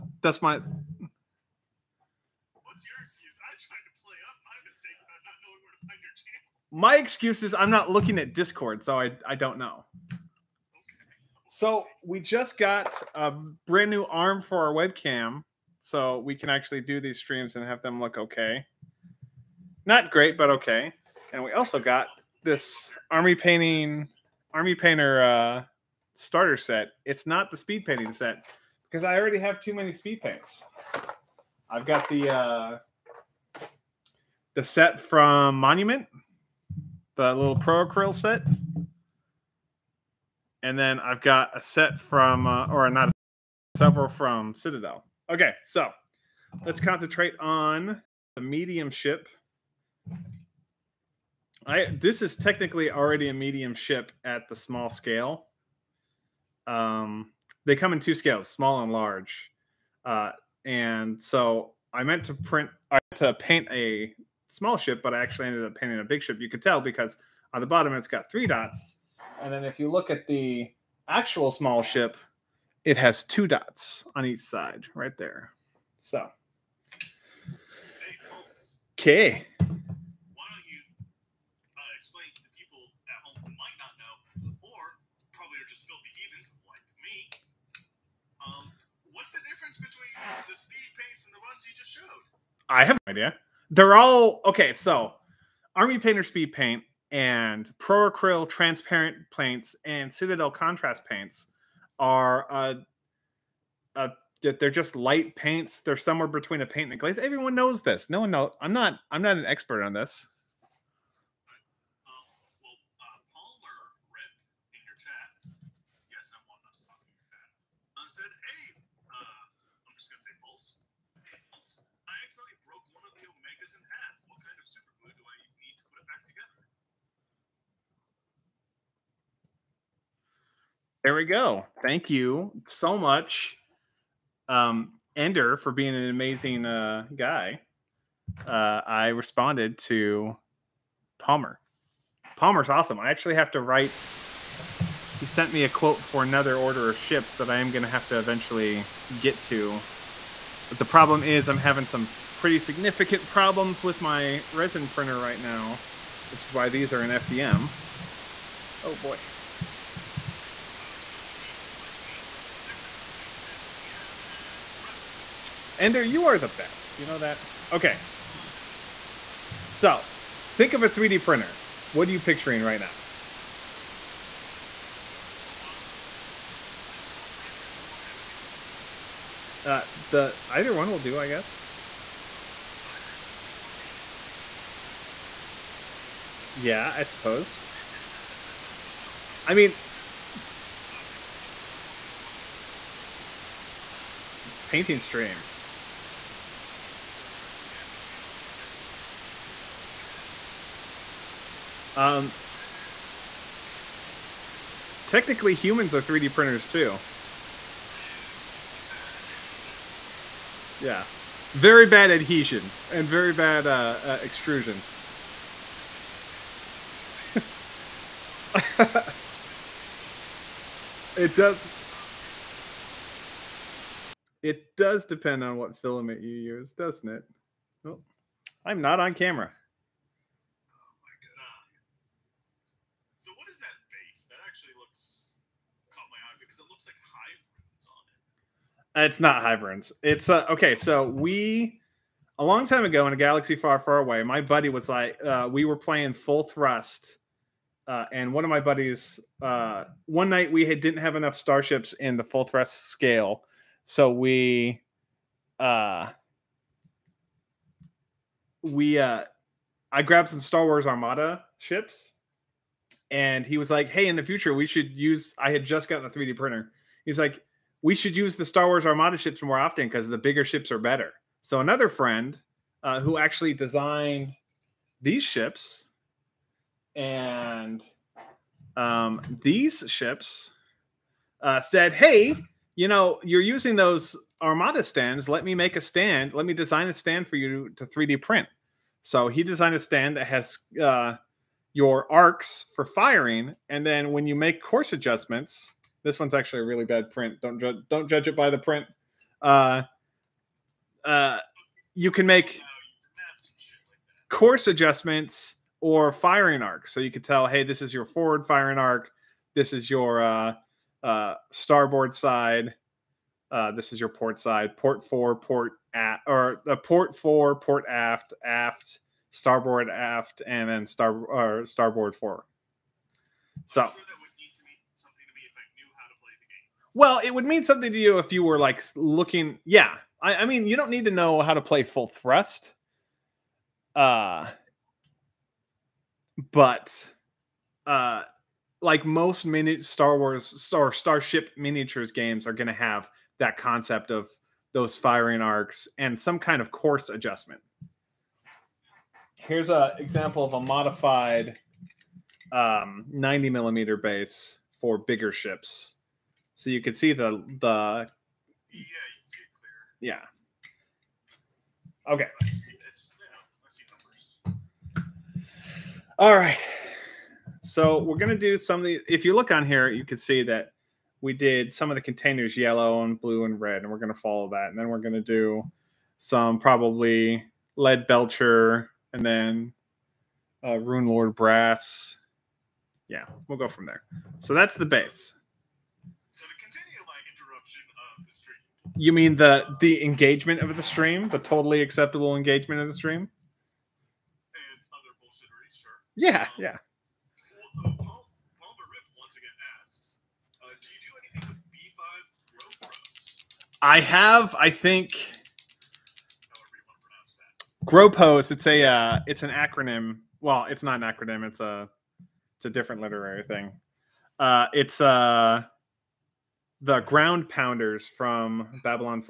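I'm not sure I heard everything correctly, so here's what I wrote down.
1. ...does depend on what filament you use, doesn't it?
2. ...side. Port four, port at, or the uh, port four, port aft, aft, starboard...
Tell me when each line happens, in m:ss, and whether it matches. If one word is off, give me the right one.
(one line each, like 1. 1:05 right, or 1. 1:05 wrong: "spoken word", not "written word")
1. 3:44 right
2. 5:14 right.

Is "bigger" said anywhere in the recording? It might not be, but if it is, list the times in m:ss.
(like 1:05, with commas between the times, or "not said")
4:30, 5:54.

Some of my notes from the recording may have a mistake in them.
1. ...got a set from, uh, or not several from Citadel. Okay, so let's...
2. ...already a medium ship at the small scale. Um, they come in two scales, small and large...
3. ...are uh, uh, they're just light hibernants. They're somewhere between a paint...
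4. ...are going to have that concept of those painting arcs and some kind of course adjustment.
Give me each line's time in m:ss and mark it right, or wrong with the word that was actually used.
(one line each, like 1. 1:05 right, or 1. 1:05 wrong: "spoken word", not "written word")
1. 0:41 right
2. 0:52 right
3. 1:41 wrong: "paints", not "hibernants"
4. 5:42 wrong: "firing", not "painting".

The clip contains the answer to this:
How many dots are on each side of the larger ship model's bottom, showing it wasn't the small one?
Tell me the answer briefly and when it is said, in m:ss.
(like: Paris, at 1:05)
3, at 1:08.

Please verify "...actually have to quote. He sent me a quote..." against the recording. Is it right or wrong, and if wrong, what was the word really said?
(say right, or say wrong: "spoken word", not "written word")
wrong: "write", not "quote".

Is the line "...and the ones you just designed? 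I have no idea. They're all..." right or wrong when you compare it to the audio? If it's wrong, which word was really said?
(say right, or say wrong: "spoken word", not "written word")
wrong: "showed", not "designed".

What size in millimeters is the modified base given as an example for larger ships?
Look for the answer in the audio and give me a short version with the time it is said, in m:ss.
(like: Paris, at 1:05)
90 millimeters, at 5:53.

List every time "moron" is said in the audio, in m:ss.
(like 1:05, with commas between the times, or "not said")
2:48.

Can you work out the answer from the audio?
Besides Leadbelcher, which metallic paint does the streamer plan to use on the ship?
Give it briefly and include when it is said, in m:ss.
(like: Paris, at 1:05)
Runelord Brass, at 6:20.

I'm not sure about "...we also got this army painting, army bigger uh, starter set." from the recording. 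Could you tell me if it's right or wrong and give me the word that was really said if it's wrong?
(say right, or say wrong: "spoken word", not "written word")
wrong: "painter", not "bigger".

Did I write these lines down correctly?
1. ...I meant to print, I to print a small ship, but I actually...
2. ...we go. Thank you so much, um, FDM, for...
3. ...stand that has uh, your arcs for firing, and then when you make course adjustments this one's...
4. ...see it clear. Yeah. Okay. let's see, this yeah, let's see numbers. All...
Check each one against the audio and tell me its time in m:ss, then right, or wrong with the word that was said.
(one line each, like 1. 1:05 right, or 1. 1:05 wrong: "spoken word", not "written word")
1. 1:01 wrong: "paint", not "print"
2. 2:11 wrong: "Ender", not "FDM"
3. 4:49 right
4. 5:59 right.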